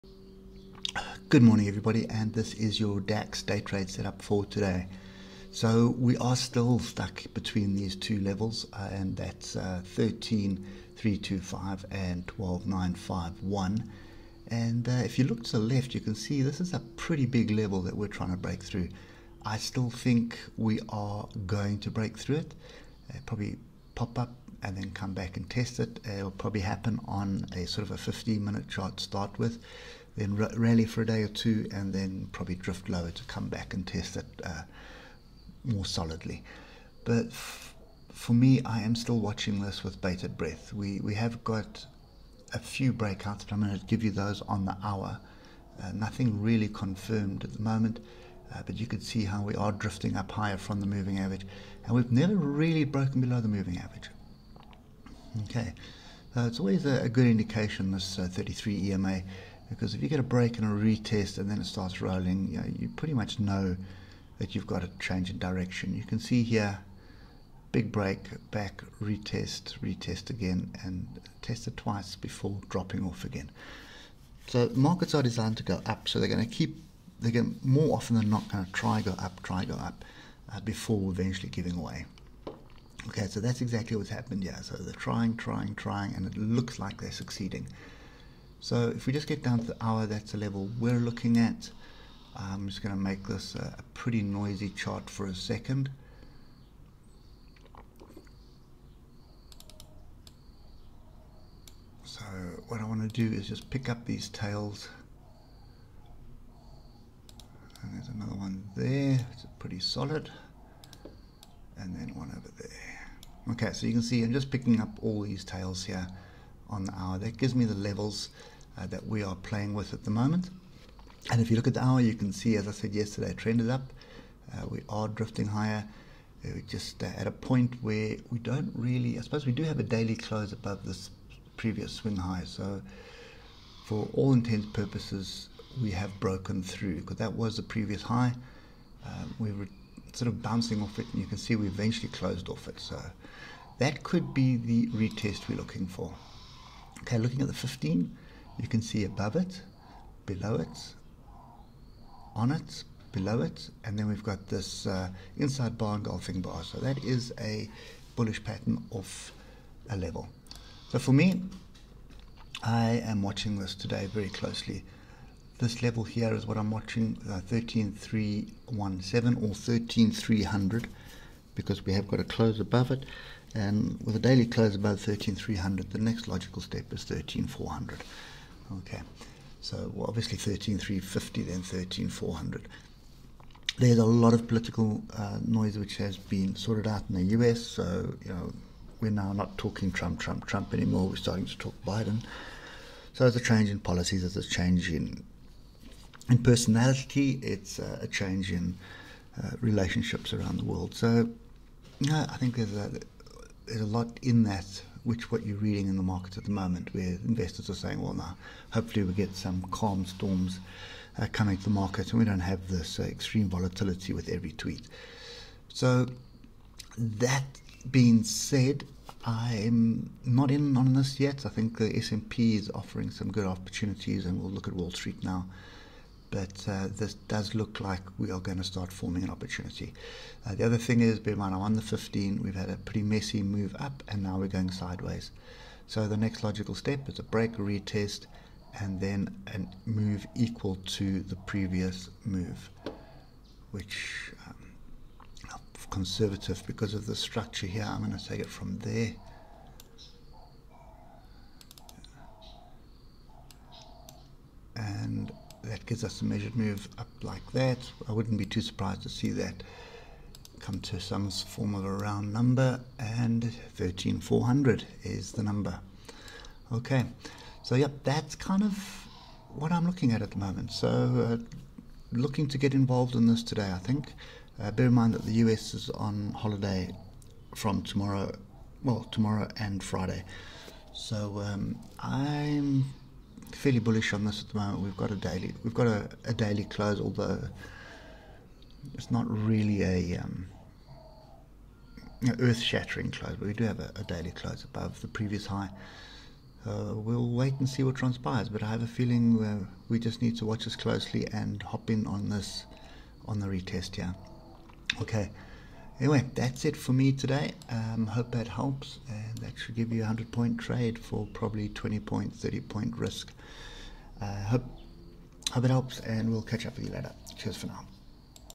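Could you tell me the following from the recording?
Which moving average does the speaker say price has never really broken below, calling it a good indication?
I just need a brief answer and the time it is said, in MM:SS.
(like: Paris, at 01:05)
33 EMA, at 00:58.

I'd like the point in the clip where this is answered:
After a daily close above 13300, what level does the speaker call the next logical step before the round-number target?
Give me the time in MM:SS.
03:00.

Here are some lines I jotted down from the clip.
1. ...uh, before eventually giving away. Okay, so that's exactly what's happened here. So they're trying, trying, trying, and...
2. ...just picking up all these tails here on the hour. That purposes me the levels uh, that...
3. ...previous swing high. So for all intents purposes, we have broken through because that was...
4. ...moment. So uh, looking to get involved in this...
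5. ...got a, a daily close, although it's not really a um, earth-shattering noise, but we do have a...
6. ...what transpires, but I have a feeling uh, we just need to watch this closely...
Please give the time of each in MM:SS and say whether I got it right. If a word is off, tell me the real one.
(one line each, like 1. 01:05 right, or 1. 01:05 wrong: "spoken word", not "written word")
1. 01:20 right
2. 01:54 wrong: "gives", not "purposes"
3. 02:11 right
4. 04:30 right
5. 04:45 wrong: "close", not "noise"
6. 04:57 right.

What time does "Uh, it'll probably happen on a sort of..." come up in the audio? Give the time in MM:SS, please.
00:26.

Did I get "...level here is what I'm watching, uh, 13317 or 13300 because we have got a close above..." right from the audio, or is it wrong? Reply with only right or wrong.
right.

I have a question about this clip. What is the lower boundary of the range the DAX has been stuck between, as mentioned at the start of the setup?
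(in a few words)
12951.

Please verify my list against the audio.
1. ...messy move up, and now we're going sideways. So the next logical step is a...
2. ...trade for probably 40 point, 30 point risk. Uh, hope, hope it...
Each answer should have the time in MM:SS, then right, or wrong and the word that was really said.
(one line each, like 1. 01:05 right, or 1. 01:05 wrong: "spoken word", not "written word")
1. 03:53 right
2. 05:10 wrong: "20", not "40".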